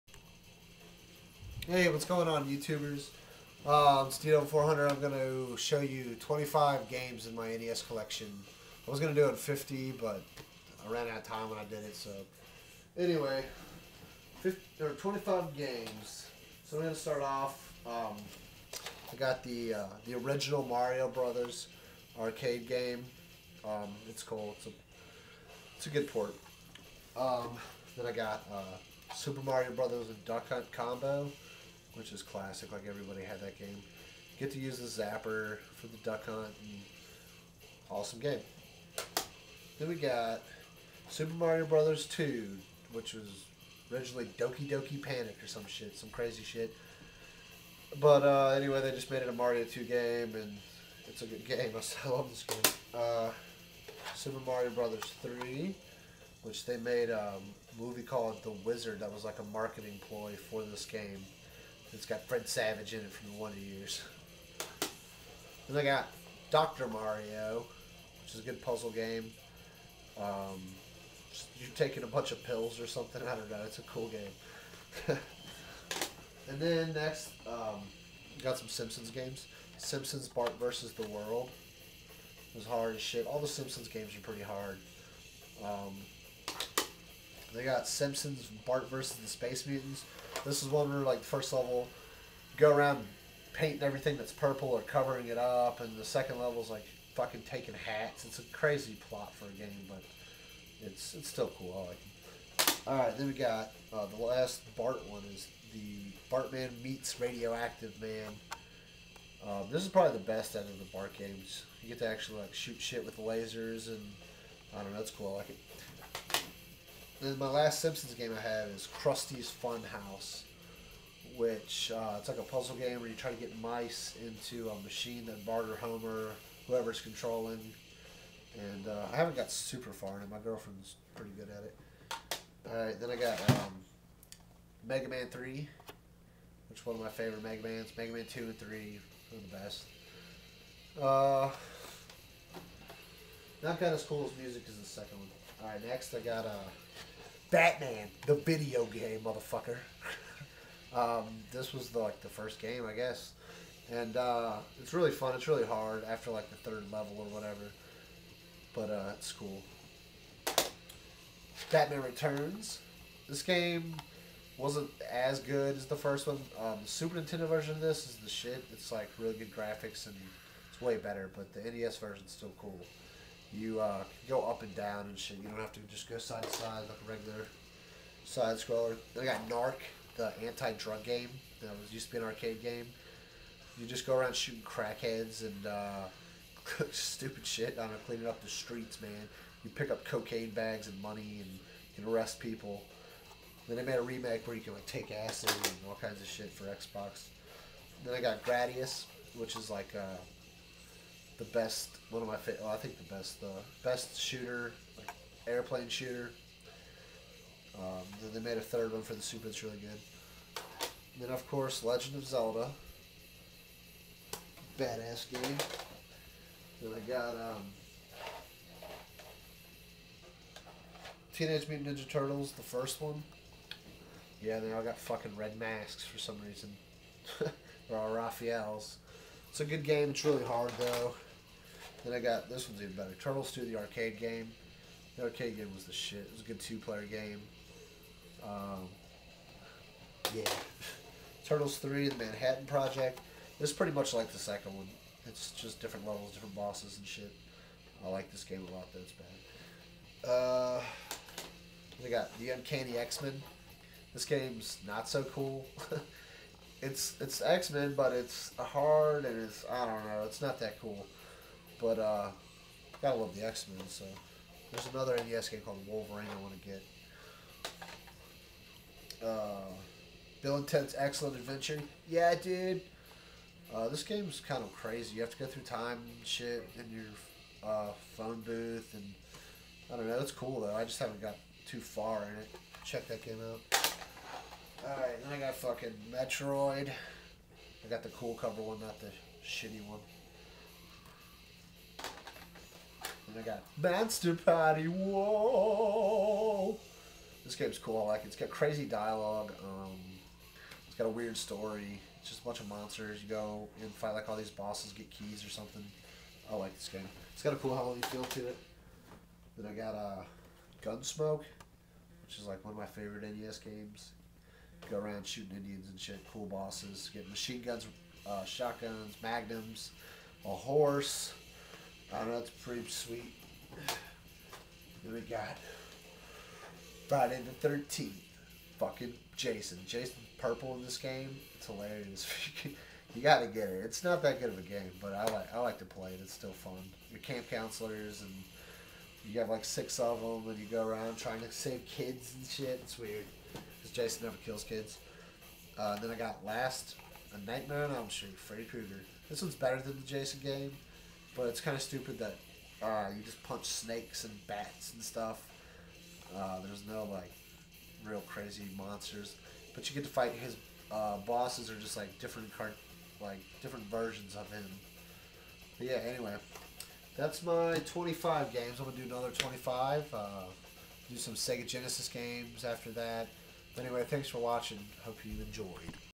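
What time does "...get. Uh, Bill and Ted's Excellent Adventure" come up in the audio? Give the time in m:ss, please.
4:26.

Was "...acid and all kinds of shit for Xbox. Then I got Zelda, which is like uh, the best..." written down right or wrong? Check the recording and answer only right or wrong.
wrong.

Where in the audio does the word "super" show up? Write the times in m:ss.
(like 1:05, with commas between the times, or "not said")
0:29, 0:41, 0:54, 2:09, 2:46, 3:29.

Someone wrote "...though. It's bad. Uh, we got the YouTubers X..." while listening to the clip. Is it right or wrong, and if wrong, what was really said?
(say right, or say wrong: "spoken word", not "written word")
wrong: "Uncanny", not "YouTubers".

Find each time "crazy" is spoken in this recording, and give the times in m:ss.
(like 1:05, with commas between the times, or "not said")
0:46, 1:38, 4:34, 4:58, 5:58.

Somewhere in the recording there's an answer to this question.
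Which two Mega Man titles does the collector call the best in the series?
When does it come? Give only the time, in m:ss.
2:17.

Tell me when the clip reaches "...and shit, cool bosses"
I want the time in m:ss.
5:15.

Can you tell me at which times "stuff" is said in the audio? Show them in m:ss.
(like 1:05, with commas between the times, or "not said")
5:55.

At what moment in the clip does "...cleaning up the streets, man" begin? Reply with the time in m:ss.
3:08.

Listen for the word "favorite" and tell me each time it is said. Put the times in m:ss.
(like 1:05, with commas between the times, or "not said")
2:17, 3:22, 5:12.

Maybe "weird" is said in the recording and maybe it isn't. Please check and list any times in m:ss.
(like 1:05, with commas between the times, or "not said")
5:01, 5:42.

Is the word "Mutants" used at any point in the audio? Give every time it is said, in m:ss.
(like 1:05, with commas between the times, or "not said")
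1:29, 3:41.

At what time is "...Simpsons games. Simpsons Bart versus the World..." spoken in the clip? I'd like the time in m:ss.
1:18.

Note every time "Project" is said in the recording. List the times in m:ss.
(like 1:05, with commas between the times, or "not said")
4:02.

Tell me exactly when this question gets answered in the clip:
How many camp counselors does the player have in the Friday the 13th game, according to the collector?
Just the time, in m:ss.
5:39.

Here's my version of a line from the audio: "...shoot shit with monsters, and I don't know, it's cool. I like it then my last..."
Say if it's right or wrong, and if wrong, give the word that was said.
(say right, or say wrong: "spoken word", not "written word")
wrong: "lasers", not "monsters".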